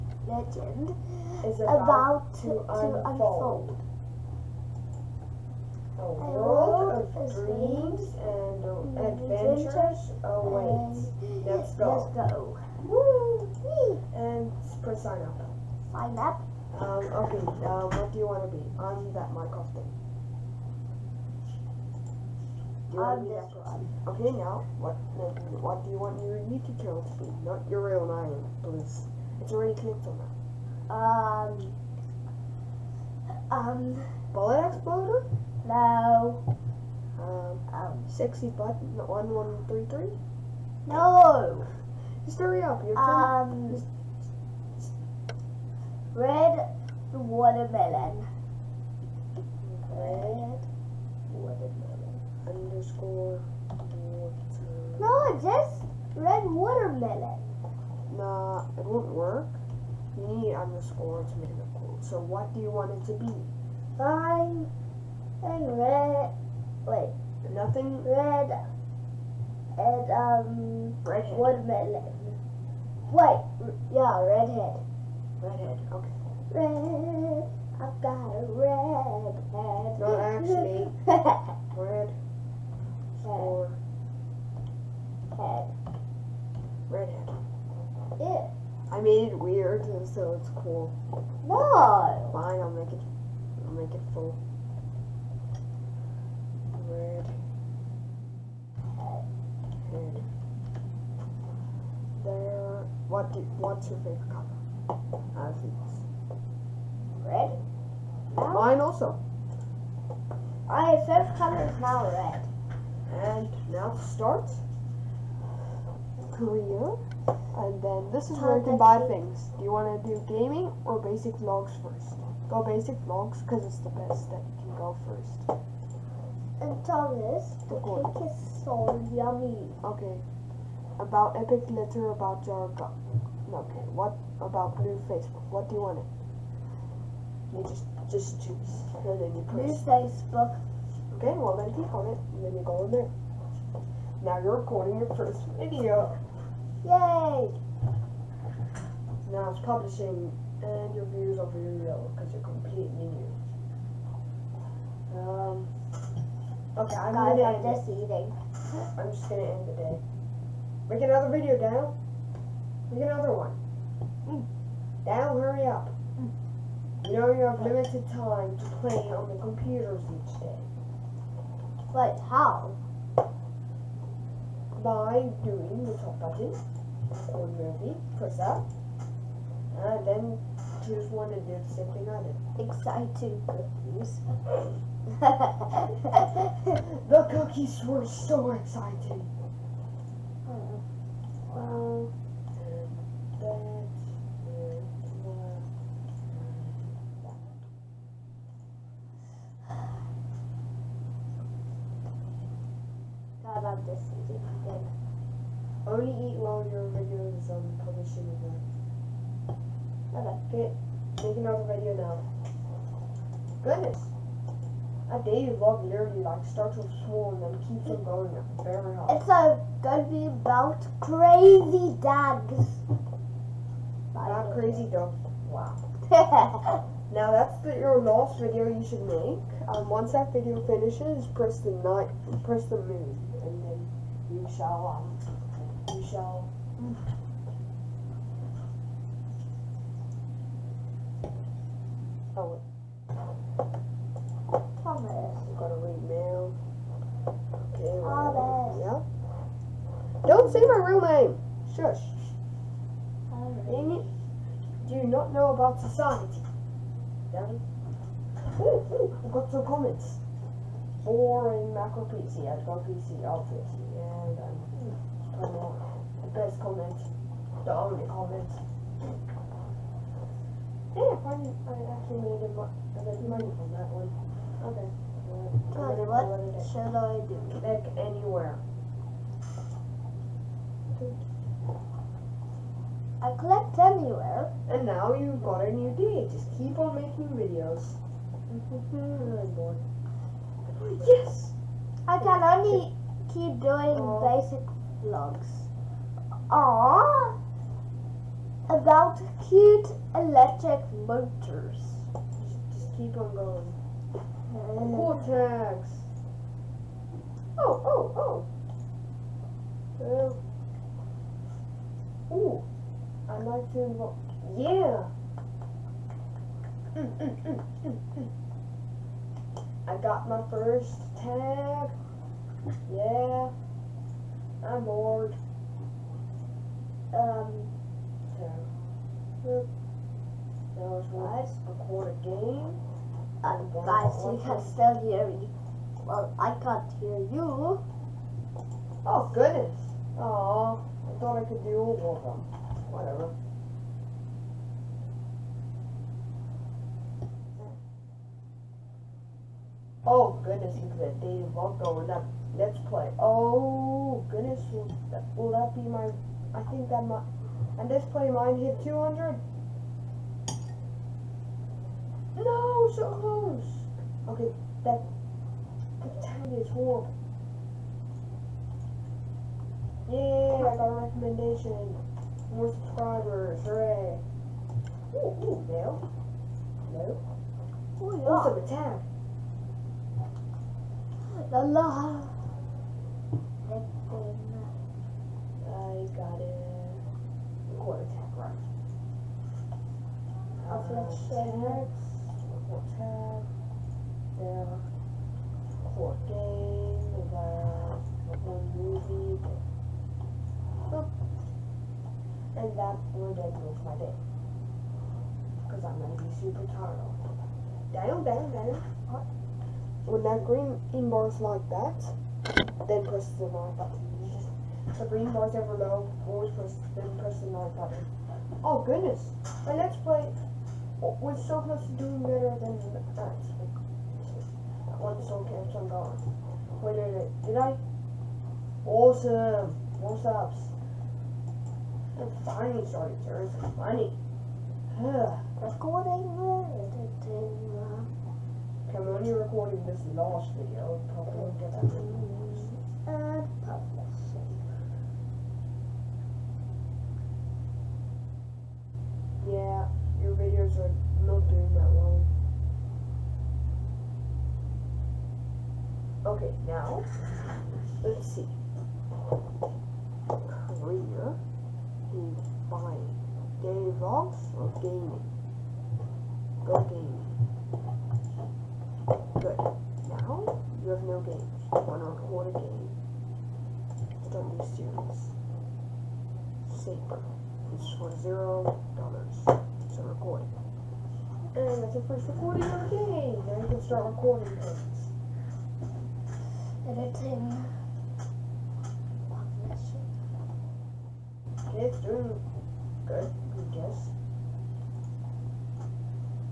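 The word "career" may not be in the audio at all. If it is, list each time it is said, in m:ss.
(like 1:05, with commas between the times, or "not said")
1:56, 7:40.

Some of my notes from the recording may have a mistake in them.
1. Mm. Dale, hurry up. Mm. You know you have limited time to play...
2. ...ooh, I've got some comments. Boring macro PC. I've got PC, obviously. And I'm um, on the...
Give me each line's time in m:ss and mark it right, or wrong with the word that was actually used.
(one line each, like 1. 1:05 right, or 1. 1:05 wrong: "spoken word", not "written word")
1. 2:44 right
2. 4:18 right.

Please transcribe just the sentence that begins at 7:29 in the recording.
Yeah, your videos are not doing that well.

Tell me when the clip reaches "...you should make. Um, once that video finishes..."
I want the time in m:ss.
3:48.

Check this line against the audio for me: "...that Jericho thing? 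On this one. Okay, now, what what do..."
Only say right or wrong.
wrong.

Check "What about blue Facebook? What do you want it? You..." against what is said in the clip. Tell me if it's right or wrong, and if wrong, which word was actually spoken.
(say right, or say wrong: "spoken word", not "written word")
right.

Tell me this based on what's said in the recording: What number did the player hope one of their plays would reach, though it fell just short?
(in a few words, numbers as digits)
200.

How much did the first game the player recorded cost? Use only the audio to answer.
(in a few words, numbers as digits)
0 dollars.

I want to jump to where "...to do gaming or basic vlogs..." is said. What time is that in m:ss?
2:00.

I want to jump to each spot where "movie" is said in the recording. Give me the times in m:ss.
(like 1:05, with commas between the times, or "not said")
2:57, 6:38.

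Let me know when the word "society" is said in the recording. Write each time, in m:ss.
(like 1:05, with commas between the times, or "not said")
4:15.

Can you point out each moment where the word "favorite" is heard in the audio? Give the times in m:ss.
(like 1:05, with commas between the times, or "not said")
1:43, 1:51.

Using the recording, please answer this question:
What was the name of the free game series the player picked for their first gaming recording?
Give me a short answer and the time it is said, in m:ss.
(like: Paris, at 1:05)
Saber, at 7:56.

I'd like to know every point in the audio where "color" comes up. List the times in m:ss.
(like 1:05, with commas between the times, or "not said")
1:44, 1:51.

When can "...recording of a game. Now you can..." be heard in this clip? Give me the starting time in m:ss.
8:02.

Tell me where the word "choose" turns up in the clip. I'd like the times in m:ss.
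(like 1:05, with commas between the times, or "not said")
2:18, 3:00.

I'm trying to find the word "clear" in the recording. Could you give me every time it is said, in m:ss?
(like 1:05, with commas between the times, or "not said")
not said.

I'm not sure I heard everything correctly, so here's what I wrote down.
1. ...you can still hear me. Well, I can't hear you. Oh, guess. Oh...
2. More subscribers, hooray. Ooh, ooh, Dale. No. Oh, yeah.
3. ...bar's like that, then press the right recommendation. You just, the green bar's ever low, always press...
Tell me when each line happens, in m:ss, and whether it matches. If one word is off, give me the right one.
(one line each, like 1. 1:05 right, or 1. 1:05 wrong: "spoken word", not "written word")
1. 5:34 wrong: "goodness", not "guess"
2. 6:12 right
3. 6:51 wrong: "button", not "recommendation".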